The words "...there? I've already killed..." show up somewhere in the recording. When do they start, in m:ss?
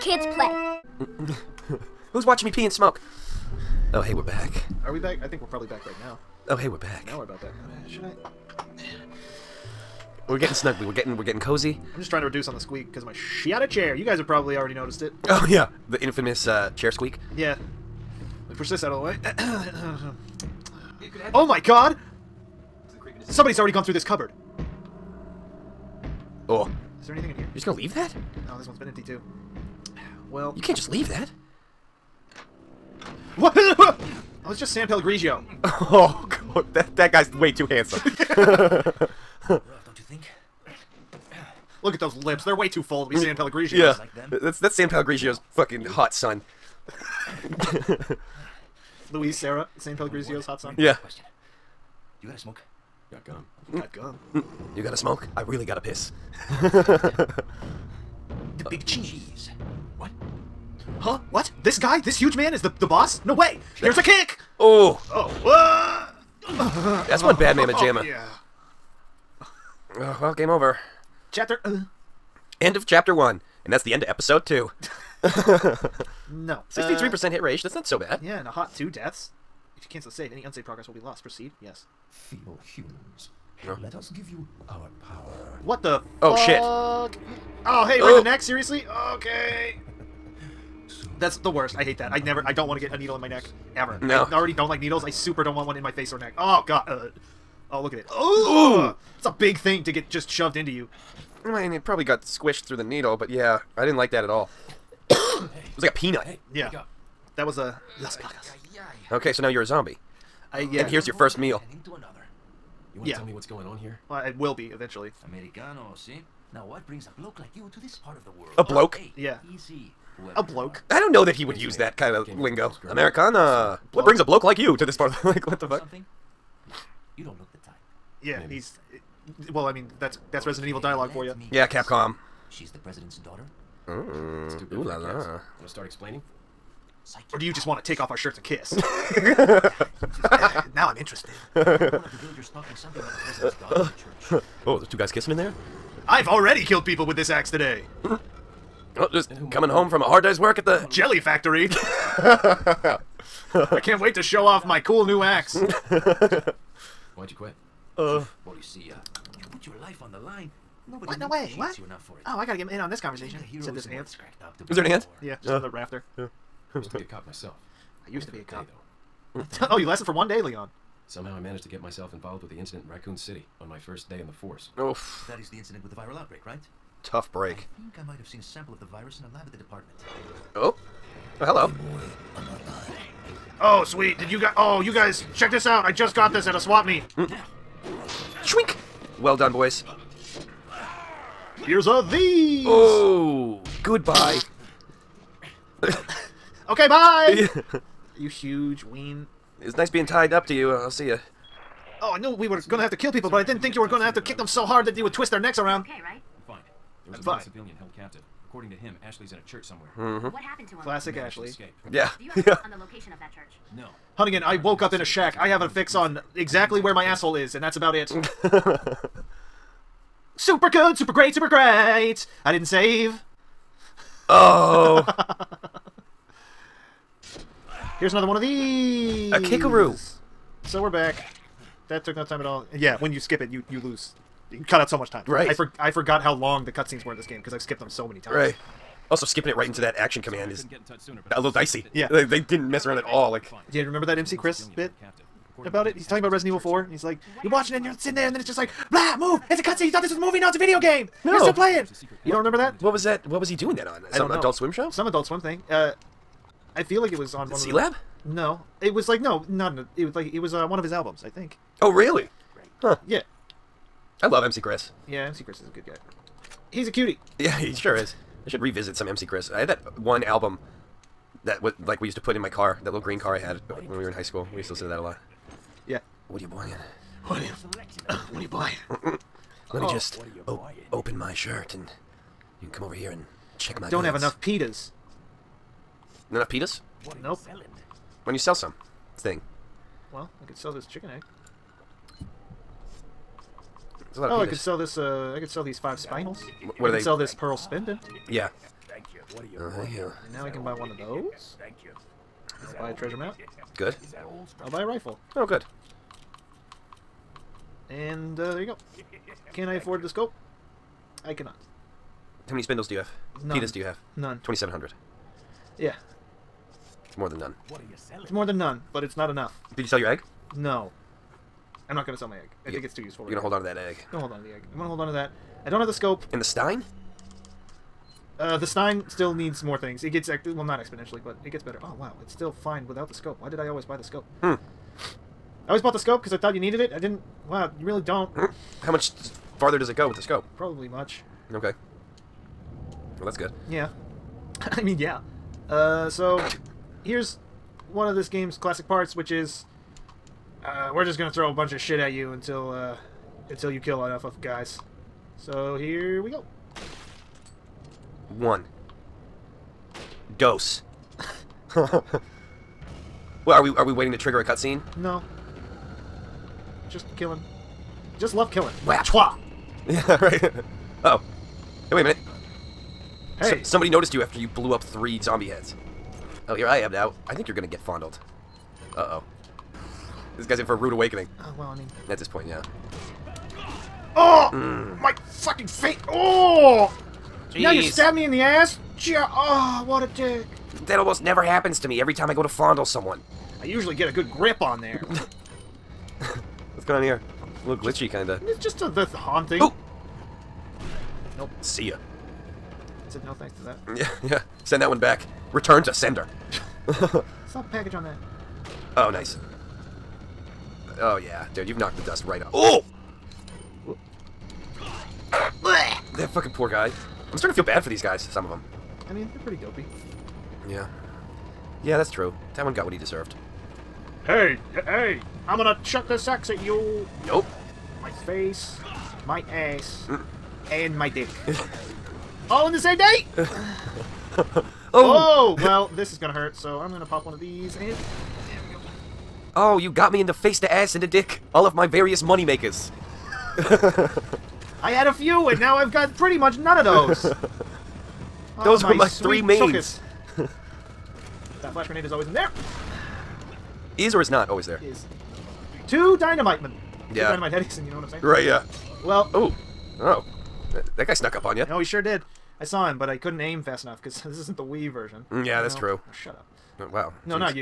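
2:25.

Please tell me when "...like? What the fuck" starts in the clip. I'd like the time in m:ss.
2:05.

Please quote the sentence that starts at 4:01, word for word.
Yeah, they, they, didn't mess around at all.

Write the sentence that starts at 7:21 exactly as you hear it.
All of my various money makers.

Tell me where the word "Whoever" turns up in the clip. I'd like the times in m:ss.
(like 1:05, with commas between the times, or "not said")
2:00.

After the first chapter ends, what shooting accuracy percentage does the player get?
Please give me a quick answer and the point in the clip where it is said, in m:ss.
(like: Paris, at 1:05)
63%, at 1:16.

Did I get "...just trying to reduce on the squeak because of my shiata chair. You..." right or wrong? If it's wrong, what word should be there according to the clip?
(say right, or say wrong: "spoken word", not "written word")
right.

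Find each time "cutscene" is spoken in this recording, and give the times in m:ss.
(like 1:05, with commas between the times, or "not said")
3:56, 4:09, 6:04.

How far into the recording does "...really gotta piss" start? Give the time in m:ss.
0:55.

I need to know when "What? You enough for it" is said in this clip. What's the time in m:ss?
2:41.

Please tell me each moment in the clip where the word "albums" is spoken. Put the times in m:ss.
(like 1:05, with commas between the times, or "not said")
4:20, 4:30.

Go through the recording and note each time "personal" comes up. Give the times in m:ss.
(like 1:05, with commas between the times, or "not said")
not said.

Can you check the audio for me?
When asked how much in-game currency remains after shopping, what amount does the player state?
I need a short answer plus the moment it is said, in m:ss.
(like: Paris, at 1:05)
2,700, at 5:14.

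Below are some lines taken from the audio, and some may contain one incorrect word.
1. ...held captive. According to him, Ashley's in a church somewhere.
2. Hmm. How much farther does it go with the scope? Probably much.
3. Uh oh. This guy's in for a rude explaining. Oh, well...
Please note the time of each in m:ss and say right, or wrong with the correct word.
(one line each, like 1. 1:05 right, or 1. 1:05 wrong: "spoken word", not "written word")
1. 3:27 right
2. 5:38 right
3. 6:18 wrong: "awakening", not "explaining".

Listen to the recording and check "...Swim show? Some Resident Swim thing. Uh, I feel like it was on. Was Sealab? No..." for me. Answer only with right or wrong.
wrong.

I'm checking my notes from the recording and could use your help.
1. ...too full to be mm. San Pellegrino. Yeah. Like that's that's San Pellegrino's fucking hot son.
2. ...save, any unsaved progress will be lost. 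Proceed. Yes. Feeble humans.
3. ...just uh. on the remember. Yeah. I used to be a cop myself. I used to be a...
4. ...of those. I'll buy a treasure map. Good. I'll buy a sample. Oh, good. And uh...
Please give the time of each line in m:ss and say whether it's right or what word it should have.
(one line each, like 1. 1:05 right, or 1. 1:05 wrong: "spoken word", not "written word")
1. 0:42 right
2. 1:20 right
3. 2:45 wrong: "rafter", not "remember"
4. 5:00 wrong: "rifle", not "sample".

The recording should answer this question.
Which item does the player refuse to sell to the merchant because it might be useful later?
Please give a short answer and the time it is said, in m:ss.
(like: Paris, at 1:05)
chicken egg, at 4:50.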